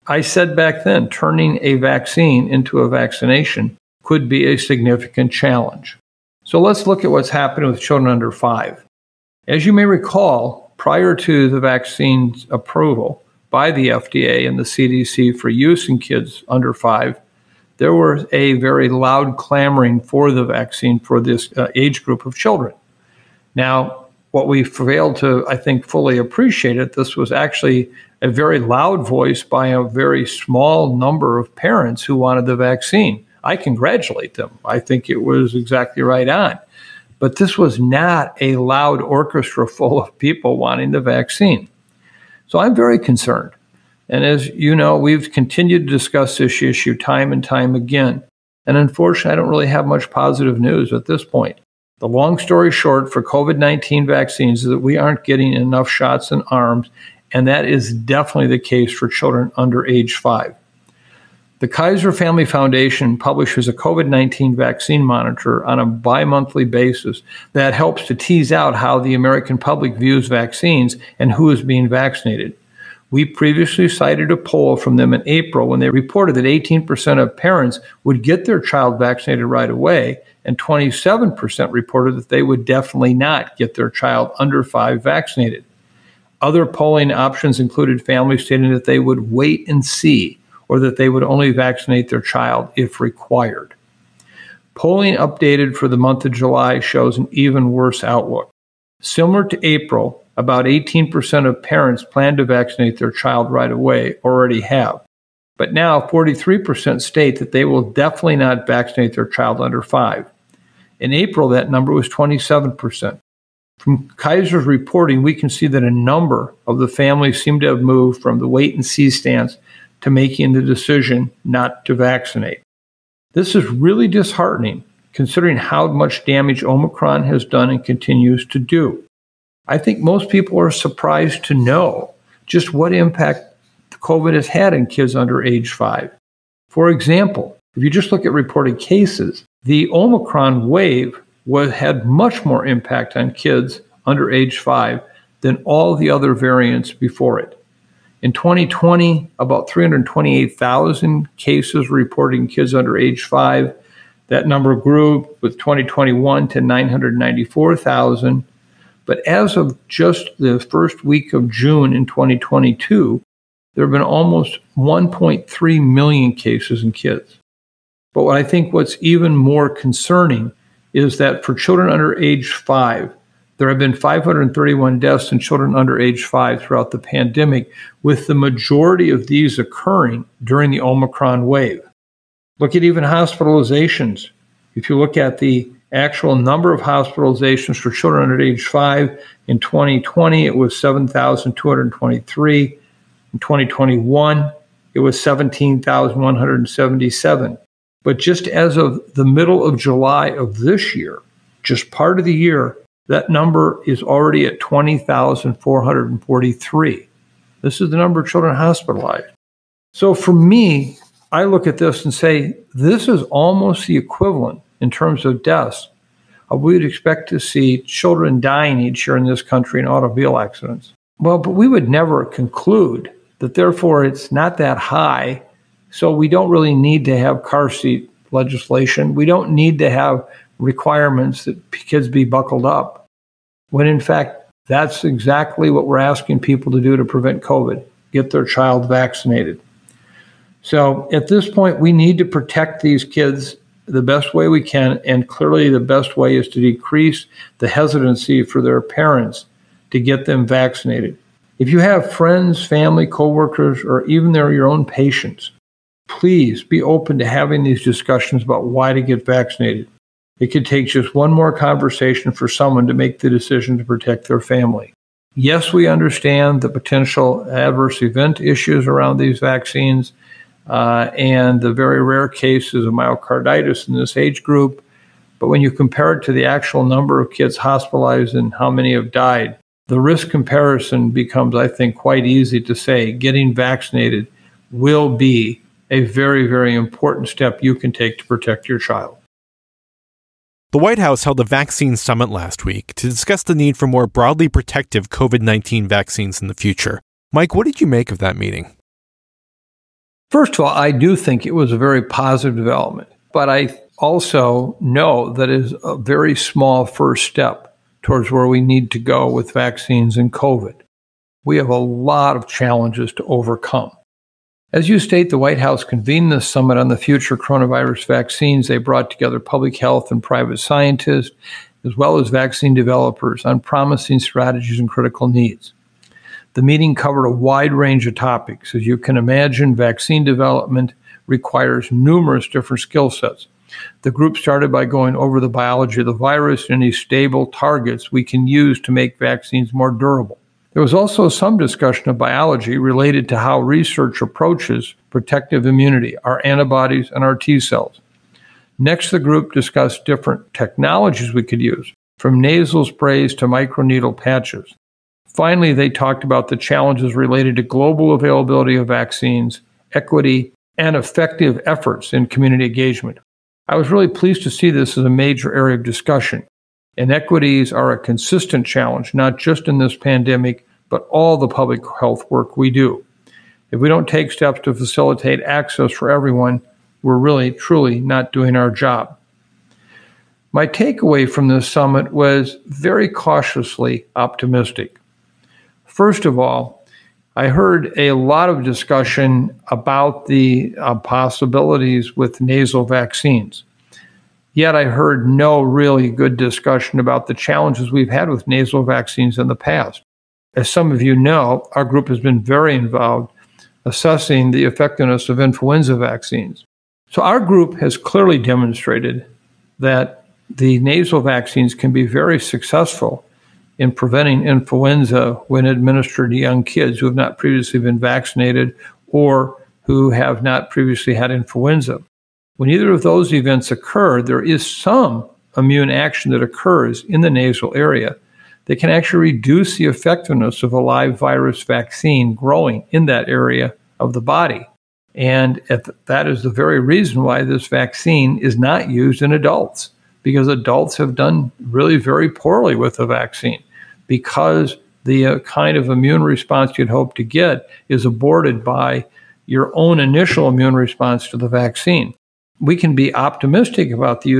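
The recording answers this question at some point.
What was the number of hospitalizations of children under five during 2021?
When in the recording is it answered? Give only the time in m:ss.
3:15.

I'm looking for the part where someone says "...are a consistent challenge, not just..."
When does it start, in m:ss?
6:07.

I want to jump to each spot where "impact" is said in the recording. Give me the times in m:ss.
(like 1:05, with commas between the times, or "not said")
2:12, 2:22.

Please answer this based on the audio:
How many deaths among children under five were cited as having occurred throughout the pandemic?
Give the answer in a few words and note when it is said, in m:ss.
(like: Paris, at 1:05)
531, at 2:53.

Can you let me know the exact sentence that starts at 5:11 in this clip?
We have a lot of challenges to overcome.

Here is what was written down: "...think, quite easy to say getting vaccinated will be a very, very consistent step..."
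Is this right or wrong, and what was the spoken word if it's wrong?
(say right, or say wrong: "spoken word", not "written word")
wrong: "important", not "consistent".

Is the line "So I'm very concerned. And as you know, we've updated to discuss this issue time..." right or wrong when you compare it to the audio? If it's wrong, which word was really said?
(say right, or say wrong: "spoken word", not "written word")
wrong: "continued", not "updated".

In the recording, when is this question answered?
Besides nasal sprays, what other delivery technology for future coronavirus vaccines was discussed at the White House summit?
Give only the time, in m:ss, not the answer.
5:53.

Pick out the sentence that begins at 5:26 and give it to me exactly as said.
The meeting covered a wide range of topics.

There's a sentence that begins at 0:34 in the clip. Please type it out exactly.
I think it was exactly right on.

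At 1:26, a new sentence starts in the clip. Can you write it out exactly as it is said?
Other polling options included families stating that they would wait and see, or that they would only vaccinate their child if required.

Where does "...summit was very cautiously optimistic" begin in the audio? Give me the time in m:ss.
6:21.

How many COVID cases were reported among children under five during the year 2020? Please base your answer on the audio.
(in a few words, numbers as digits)
328,000.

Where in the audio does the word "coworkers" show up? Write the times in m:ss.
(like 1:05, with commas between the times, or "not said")
4:13.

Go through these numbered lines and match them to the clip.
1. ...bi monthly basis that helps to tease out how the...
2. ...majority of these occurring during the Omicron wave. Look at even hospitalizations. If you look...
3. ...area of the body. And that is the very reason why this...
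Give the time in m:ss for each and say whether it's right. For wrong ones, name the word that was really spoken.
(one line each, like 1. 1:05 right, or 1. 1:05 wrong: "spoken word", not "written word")
1. 1:05 right
2. 2:58 right
3. 7:13 right.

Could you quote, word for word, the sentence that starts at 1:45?
But now 43% state that they will definitely not vaccinate their child under five.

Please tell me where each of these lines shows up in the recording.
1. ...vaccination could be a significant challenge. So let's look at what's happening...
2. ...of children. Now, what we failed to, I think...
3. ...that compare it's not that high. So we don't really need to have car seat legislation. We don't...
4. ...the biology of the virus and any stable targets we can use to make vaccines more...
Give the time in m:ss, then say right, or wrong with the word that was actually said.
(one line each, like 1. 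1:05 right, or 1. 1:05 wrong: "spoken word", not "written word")
1. 0:02 right
2. 0:22 right
3. 3:43 wrong: "therefore", not "compare"
4. 5:35 right.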